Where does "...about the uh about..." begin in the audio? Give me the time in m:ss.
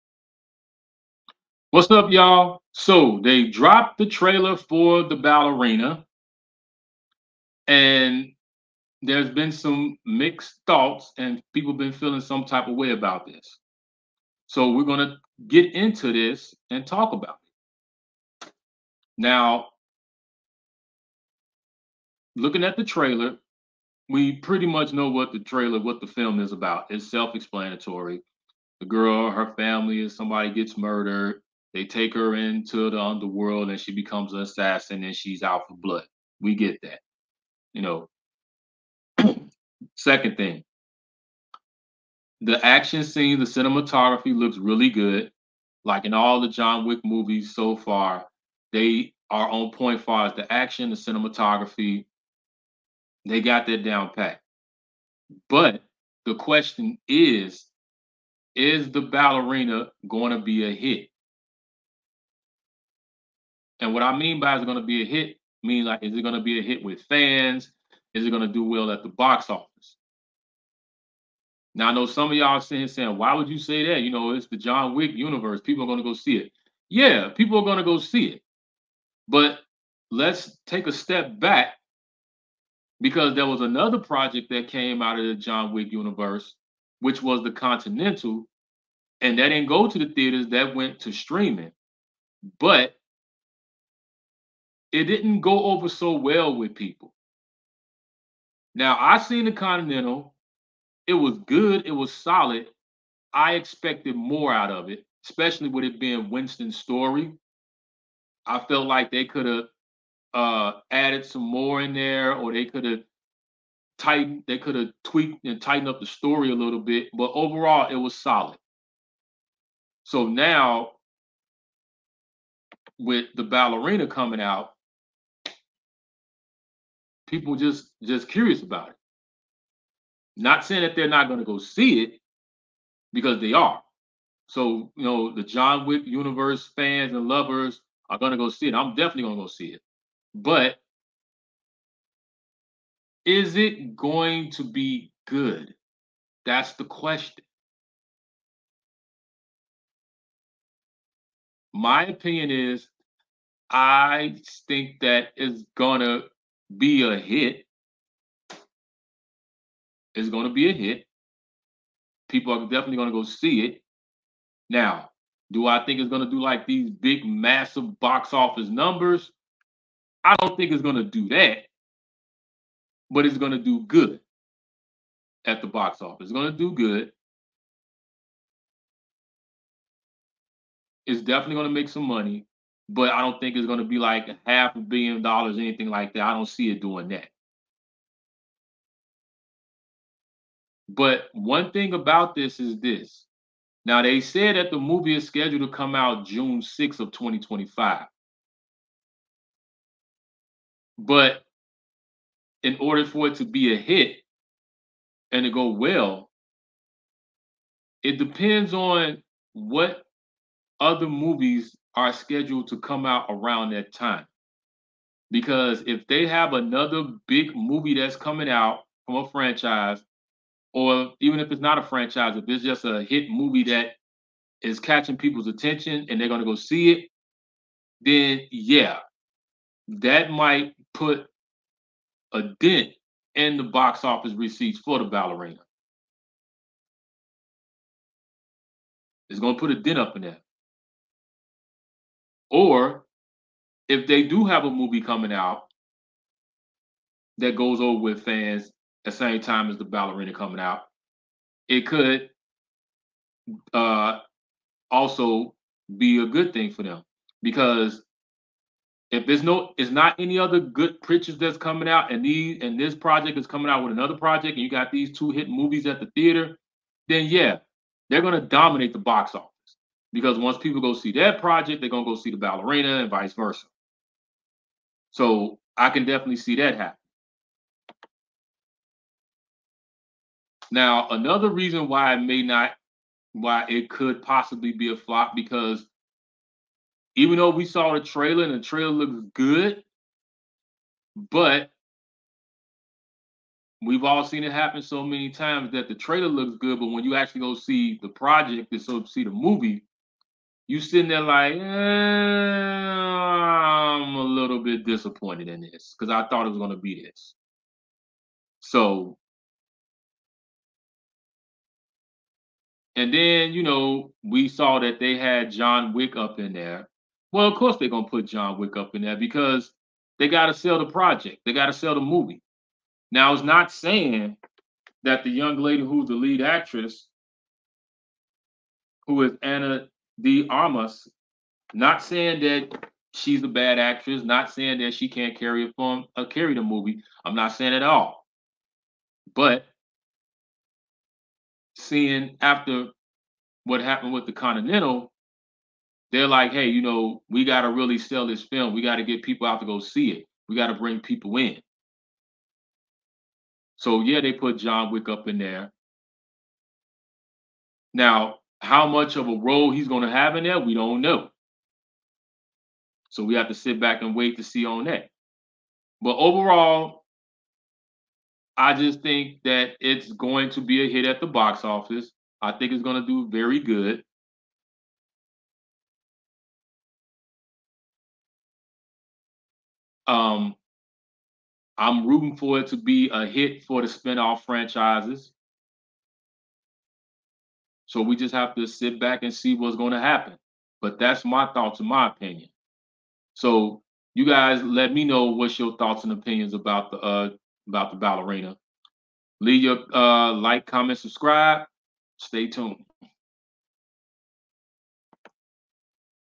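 6:36.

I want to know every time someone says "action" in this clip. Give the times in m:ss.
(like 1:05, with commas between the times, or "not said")
0:42, 0:50.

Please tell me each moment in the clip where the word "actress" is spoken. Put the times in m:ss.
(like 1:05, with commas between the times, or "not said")
5:26, 5:33.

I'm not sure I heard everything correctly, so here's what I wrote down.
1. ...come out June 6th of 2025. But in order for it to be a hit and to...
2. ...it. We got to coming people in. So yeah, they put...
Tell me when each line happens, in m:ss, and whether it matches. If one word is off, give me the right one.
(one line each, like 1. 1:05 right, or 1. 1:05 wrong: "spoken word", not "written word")
1. 3:15 right
2. 5:50 wrong: "bring", not "coming".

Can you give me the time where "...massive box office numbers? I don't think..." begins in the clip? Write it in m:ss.
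2:47.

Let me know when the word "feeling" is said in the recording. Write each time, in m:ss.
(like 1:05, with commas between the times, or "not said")
0:11.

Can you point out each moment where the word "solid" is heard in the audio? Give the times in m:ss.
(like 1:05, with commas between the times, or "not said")
1:42, 1:58.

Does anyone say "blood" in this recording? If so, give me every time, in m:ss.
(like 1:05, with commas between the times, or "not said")
0:35.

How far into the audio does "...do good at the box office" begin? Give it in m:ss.
2:53.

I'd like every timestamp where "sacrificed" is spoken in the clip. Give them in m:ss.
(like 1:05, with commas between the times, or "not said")
not said.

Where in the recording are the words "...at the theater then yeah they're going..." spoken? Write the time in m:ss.
4:25.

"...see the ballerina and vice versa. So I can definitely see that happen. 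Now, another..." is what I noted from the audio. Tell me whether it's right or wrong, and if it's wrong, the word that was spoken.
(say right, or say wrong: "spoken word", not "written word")
right.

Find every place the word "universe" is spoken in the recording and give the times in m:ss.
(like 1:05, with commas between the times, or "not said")
1:15, 1:25, 2:16.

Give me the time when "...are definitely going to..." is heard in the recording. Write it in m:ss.
2:42.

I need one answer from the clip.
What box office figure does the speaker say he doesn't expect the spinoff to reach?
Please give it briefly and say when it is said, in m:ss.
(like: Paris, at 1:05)
half a billion dollars, at 3:04.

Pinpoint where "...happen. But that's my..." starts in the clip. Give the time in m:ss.
6:29.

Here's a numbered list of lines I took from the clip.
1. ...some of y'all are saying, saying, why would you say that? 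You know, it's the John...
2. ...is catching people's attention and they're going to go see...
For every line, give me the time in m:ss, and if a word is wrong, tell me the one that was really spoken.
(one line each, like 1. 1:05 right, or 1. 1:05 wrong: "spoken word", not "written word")
1. 1:12 right
2. 3:44 right.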